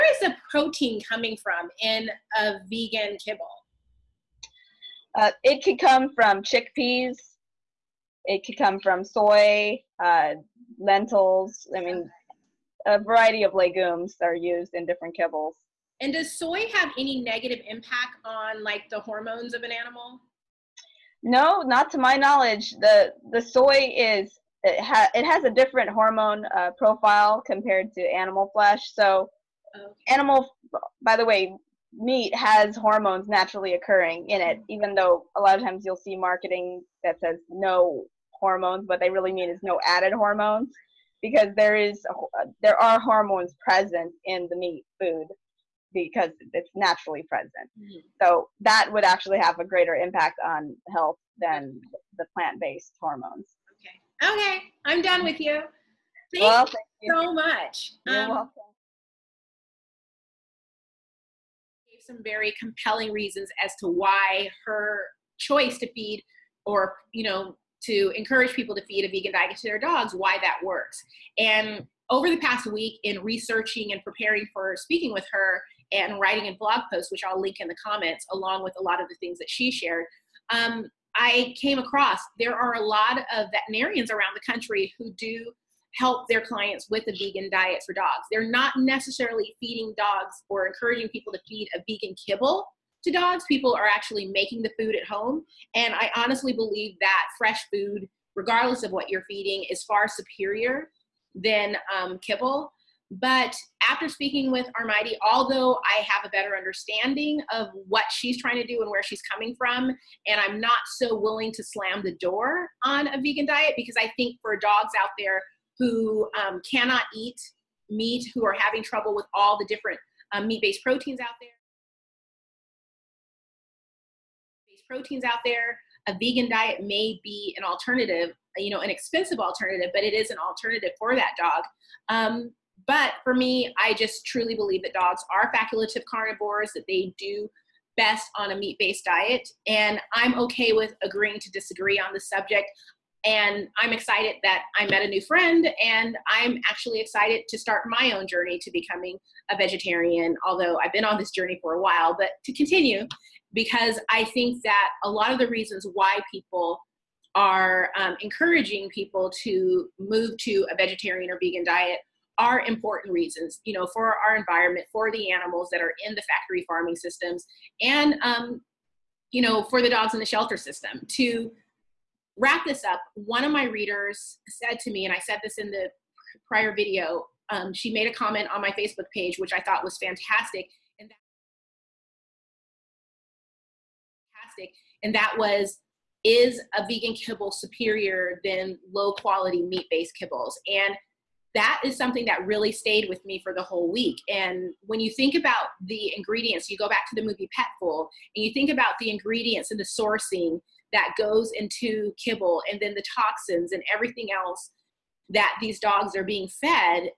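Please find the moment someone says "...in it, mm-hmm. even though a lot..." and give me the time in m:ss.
0:34.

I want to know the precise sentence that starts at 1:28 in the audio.
They're not necessarily feeding dogs or encouraging people to feed a vegan kibble to dogs.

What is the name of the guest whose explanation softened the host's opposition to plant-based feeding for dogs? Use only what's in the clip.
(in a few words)
Armaiti.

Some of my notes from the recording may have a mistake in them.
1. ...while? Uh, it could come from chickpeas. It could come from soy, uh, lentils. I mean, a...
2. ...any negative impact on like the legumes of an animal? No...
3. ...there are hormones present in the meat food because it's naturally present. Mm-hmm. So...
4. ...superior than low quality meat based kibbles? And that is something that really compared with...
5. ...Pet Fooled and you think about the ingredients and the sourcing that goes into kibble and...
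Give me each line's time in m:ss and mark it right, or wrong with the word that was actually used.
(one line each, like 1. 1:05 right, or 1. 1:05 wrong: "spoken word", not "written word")
1. 0:03 wrong: "kibble", not "while"
2. 0:16 wrong: "hormones", not "legumes"
3. 0:42 right
4. 3:07 wrong: "stayed", not "compared"
5. 3:17 right.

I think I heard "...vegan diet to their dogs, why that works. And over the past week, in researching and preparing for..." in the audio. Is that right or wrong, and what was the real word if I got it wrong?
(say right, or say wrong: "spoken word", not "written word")
right.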